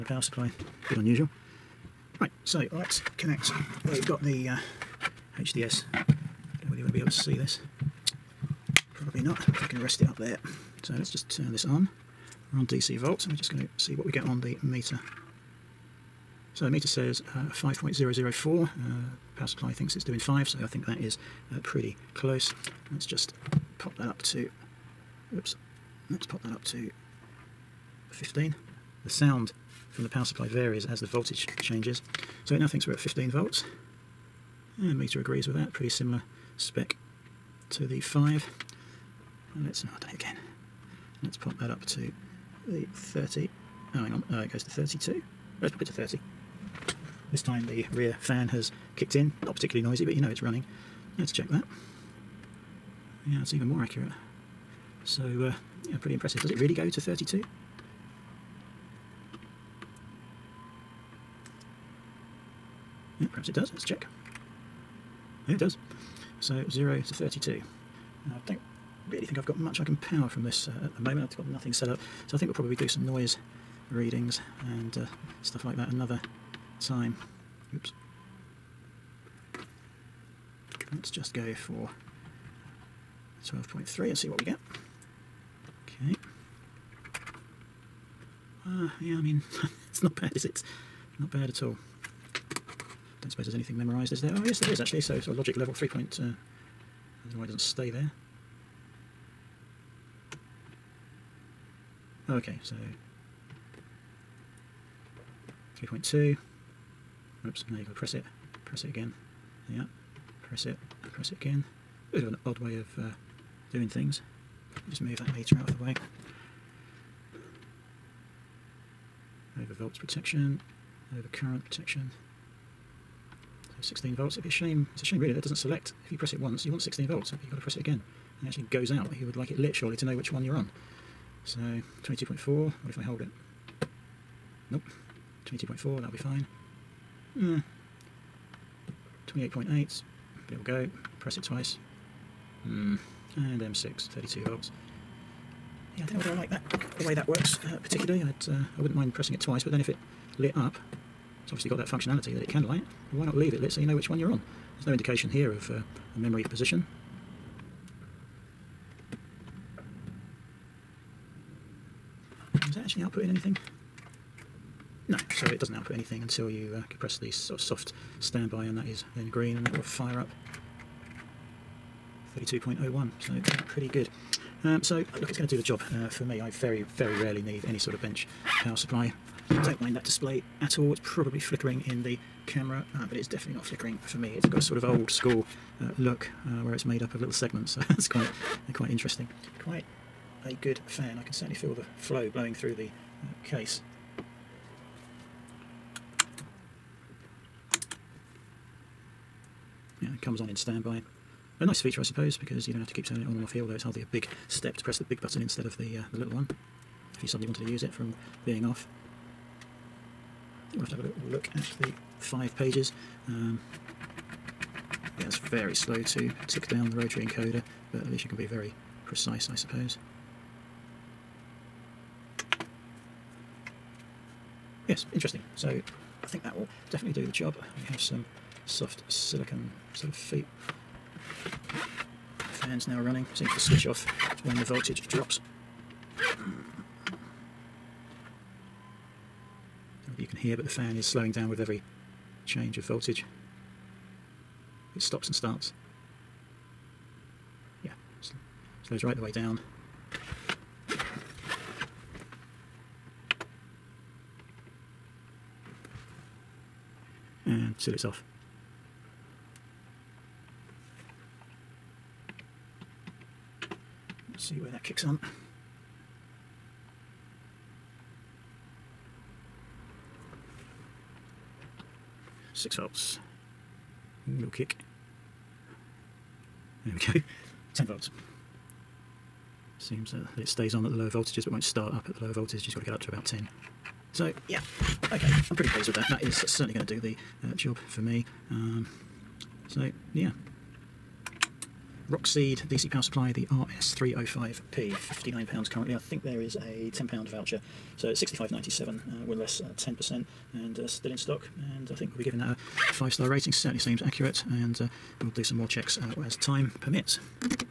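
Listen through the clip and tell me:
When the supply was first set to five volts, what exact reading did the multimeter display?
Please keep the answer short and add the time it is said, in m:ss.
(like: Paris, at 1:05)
5.004, at 0:17.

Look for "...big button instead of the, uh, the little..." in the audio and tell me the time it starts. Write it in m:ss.
3:25.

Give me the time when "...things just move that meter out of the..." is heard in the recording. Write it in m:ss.
1:53.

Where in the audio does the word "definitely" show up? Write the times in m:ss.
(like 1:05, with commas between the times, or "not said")
3:03, 3:46.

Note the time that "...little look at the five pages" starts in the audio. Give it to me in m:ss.
3:31.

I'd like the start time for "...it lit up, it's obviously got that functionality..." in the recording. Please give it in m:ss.
2:29.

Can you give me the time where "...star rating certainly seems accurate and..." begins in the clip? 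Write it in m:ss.
5:03.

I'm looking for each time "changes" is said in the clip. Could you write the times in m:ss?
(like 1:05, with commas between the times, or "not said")
0:31, 4:02.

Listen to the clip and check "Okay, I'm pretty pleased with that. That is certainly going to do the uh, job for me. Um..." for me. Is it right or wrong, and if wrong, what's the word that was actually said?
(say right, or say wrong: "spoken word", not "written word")
right.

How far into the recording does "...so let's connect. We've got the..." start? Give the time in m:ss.
0:02.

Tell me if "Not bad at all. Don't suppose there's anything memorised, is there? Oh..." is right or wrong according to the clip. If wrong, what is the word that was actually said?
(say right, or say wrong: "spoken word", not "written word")
right.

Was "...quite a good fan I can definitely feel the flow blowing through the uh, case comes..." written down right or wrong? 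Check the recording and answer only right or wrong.
wrong.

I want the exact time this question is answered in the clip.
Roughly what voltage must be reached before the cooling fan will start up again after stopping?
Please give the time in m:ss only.
4:37.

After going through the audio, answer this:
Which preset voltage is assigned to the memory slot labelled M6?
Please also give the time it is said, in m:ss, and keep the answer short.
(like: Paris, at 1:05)
32 volts, at 2:24.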